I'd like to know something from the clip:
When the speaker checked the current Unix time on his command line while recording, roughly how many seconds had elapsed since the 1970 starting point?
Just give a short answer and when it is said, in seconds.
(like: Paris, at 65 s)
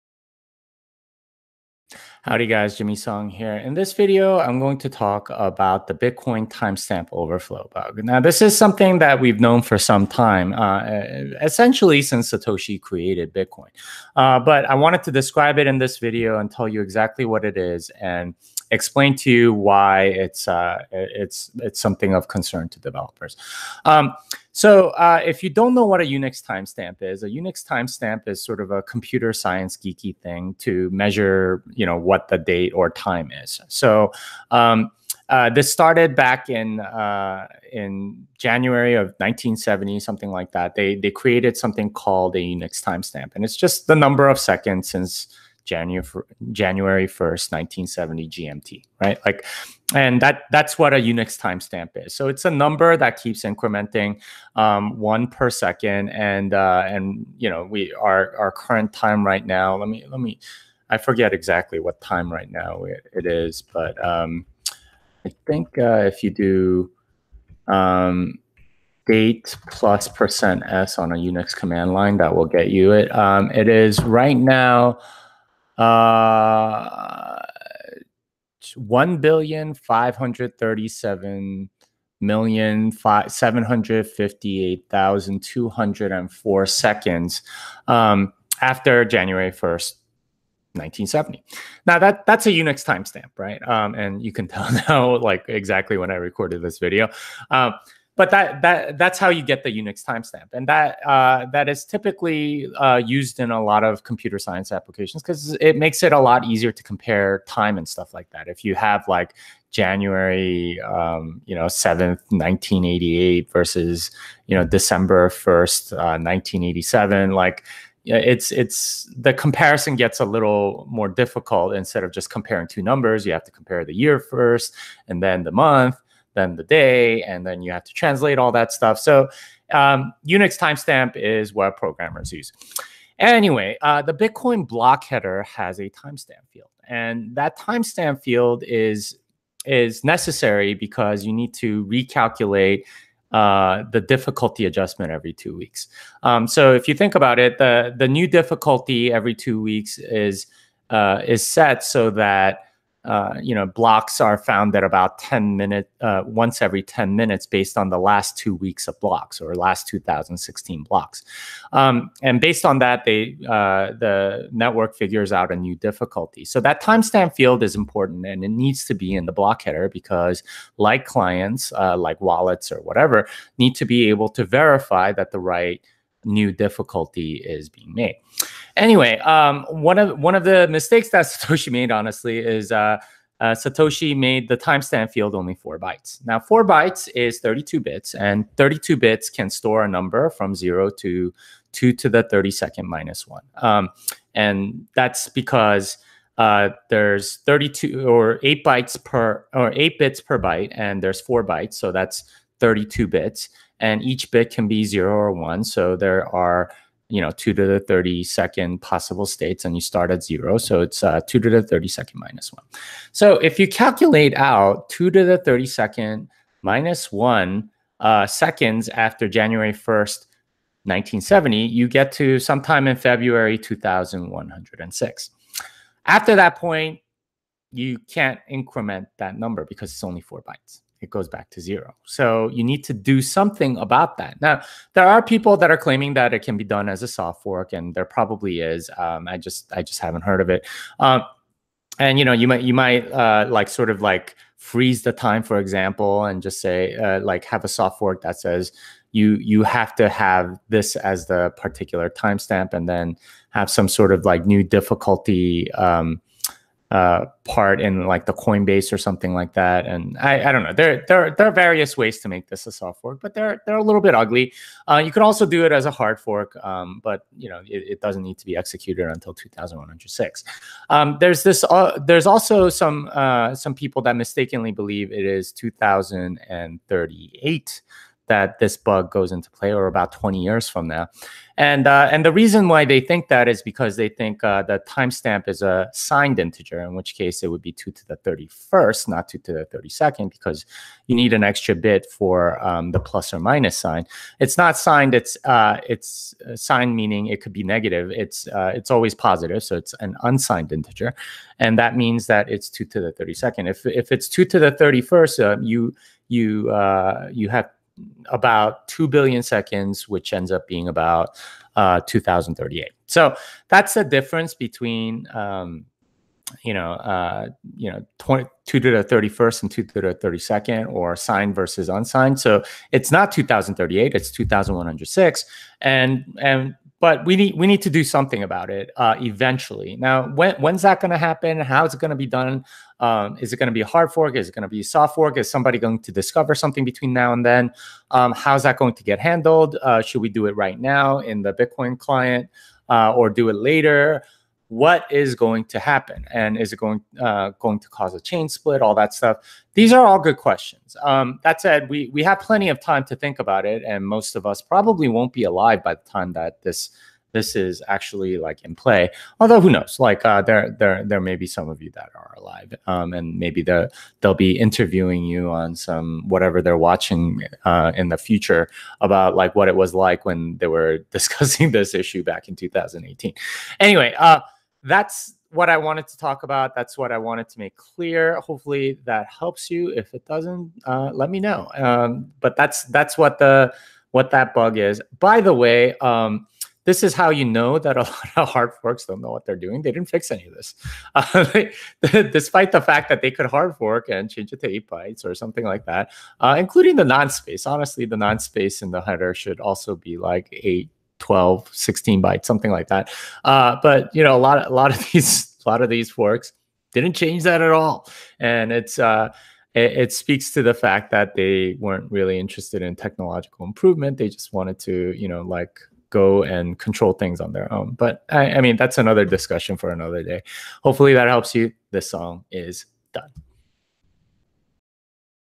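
1,537,758,204, at 78 s.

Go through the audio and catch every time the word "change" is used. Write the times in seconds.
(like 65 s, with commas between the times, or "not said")
394 s, 407 s.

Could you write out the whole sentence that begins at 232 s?
So you need to do something about that.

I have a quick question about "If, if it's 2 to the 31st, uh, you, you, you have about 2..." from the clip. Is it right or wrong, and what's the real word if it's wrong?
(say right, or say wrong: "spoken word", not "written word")
right.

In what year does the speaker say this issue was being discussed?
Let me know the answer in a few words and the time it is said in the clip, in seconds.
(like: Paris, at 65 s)
2018, at 372 s.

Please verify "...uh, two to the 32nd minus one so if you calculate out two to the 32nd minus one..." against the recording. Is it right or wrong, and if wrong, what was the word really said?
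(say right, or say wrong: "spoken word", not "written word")
right.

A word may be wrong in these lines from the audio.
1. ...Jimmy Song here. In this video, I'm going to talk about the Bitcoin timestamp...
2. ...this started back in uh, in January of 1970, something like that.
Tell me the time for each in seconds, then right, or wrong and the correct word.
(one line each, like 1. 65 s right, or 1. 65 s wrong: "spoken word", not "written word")
1. 2 s right
2. 35 s right.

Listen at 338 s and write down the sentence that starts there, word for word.
Um, how's that going to get handled?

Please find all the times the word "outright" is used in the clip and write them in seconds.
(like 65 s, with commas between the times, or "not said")
not said.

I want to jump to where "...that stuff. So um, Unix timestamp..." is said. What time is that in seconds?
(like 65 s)
128 s.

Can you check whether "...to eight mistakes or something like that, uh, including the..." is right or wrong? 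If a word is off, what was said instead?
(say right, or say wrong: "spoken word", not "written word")
wrong: "bytes", not "mistakes".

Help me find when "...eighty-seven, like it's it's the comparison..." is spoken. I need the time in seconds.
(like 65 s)
116 s.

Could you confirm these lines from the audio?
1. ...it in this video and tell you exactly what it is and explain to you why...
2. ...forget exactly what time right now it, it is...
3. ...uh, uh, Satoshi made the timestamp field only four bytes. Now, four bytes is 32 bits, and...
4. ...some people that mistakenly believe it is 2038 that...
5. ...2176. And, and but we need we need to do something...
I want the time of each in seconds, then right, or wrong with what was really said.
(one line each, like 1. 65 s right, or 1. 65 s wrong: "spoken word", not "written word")
1. 15 s right
2. 60 s right
3. 182 s right
4. 273 s right
5. 324 s wrong: "2106", not "2176".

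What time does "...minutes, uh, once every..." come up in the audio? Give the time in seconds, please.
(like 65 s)
155 s.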